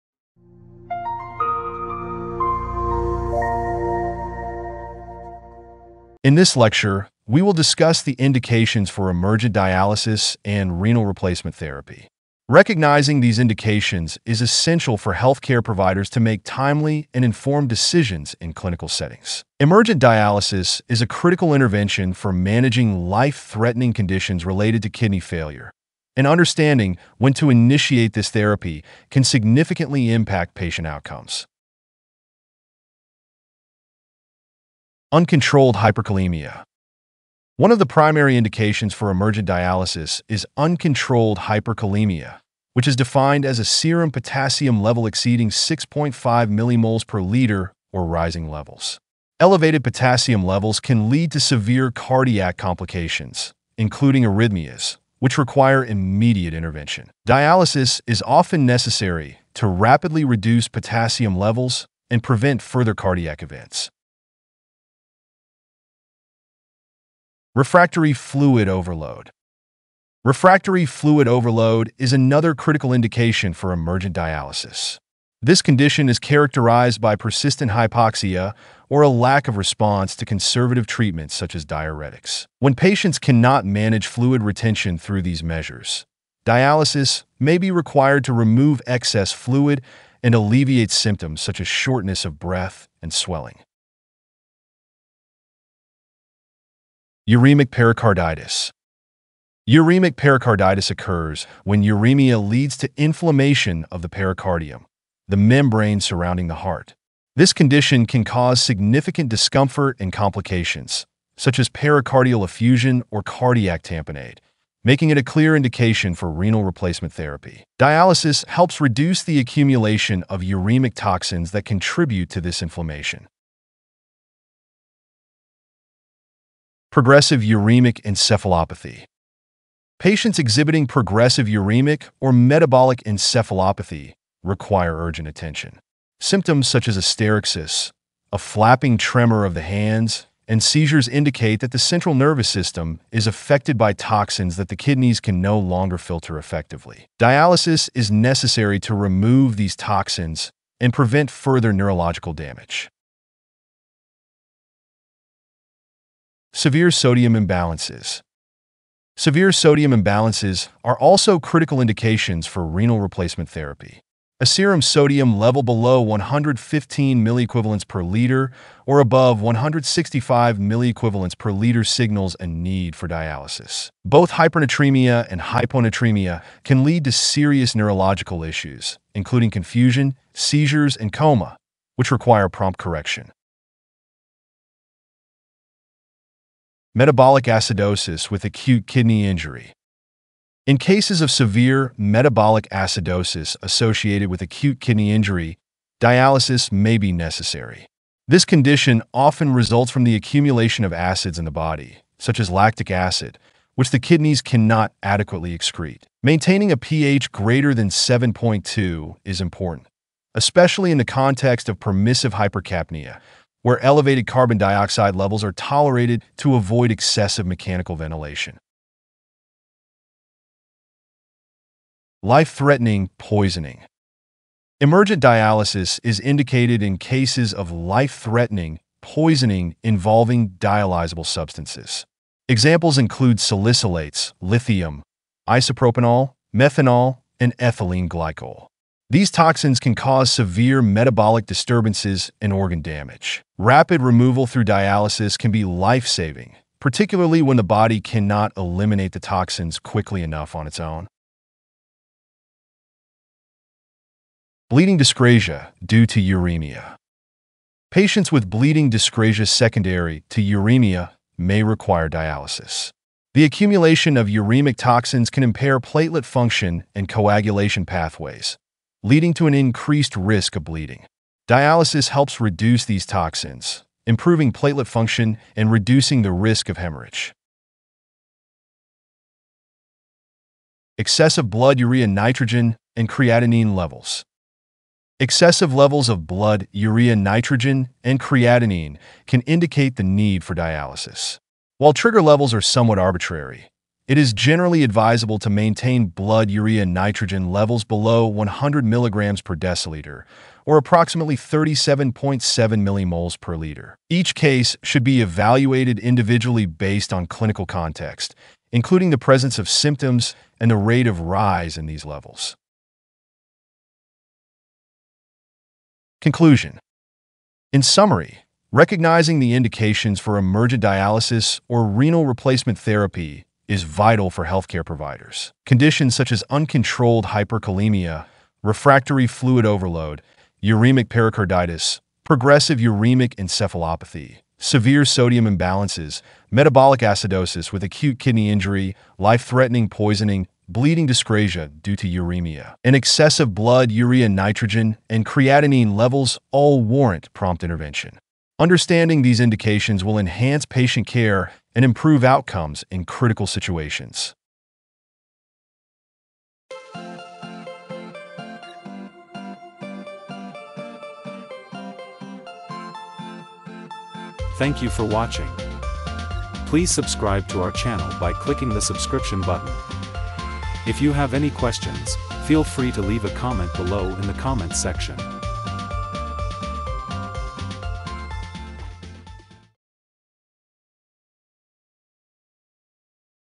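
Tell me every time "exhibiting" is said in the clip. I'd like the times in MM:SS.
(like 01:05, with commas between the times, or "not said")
02:10.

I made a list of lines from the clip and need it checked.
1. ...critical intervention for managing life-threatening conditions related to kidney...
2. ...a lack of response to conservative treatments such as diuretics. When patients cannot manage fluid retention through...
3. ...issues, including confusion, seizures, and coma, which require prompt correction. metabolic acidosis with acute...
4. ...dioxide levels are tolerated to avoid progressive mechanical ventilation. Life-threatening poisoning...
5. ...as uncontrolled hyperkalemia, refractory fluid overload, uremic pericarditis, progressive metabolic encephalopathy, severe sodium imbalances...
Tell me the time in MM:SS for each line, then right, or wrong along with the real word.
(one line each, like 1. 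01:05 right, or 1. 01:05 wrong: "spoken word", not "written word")
1. 00:21 right
2. 01:19 right
3. 02:58 right
4. 03:34 wrong: "excessive", not "progressive"
5. 05:26 wrong: "uremic", not "metabolic".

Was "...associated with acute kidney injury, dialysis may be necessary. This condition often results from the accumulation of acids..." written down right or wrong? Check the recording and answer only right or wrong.
right.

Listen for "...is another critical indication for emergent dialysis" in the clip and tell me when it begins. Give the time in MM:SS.
01:11.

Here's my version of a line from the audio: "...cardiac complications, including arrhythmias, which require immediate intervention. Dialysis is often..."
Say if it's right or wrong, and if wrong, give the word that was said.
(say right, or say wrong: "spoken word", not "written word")
right.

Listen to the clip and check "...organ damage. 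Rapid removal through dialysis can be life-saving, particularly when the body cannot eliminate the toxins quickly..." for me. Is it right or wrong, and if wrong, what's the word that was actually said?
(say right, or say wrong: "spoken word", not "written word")
right.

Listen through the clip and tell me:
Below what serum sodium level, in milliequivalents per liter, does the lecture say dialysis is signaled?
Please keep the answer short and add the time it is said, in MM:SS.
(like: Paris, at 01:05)
115, at 02:46.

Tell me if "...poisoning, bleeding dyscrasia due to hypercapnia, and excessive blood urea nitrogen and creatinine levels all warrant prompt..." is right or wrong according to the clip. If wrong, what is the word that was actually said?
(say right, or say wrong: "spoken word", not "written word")
wrong: "uremia", not "hypercapnia".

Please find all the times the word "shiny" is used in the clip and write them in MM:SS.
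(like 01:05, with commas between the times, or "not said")
not said.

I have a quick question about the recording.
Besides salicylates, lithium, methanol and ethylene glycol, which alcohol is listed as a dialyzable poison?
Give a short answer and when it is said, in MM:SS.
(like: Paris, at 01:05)
Isopropanol, at 03:55.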